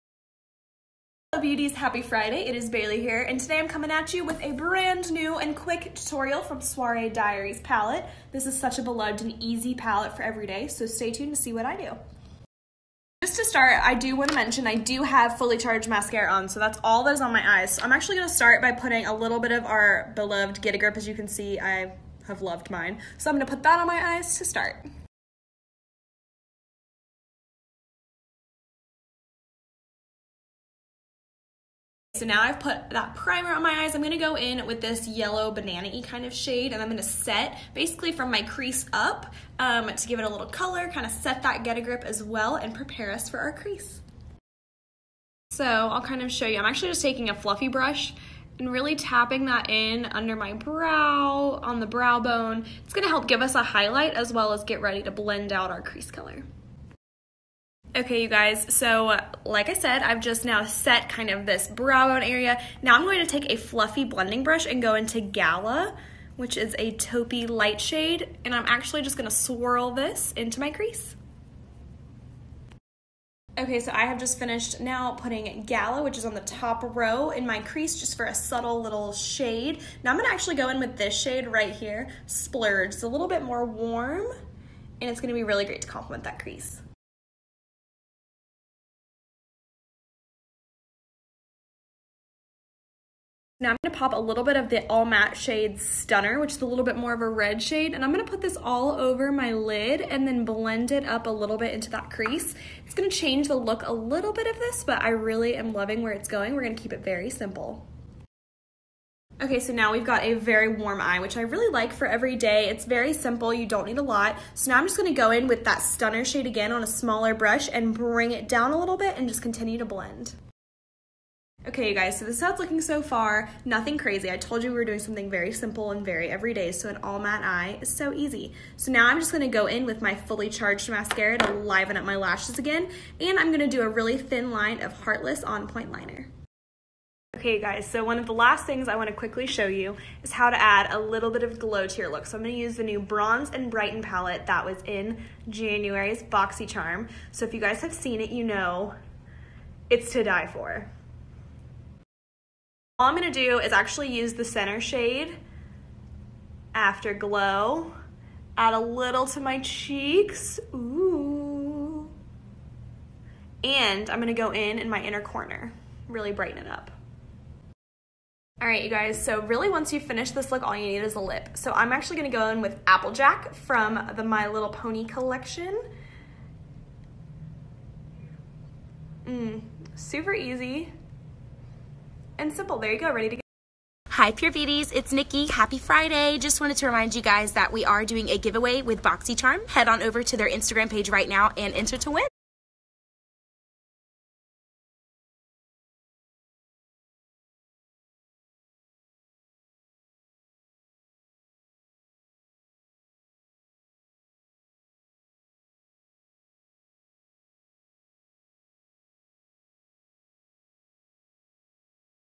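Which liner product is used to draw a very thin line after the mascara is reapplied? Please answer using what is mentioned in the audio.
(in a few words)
Heartless On Point Liner.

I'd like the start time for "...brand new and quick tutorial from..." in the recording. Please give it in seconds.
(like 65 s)
4 s.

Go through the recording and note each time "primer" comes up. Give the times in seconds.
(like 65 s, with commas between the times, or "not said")
33 s.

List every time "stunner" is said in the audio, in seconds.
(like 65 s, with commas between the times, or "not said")
95 s, 115 s.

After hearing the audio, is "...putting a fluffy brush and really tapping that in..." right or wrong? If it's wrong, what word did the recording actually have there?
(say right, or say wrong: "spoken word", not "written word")
wrong: "taking", not "putting".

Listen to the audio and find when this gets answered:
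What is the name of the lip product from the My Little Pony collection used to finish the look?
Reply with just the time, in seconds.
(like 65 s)
172 s.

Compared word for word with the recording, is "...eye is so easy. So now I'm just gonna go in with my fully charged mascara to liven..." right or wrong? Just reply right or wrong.
right.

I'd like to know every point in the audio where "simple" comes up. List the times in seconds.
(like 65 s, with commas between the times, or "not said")
107 s, 113 s, 125 s, 182 s.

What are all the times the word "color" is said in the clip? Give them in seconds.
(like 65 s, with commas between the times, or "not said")
40 s, 56 s.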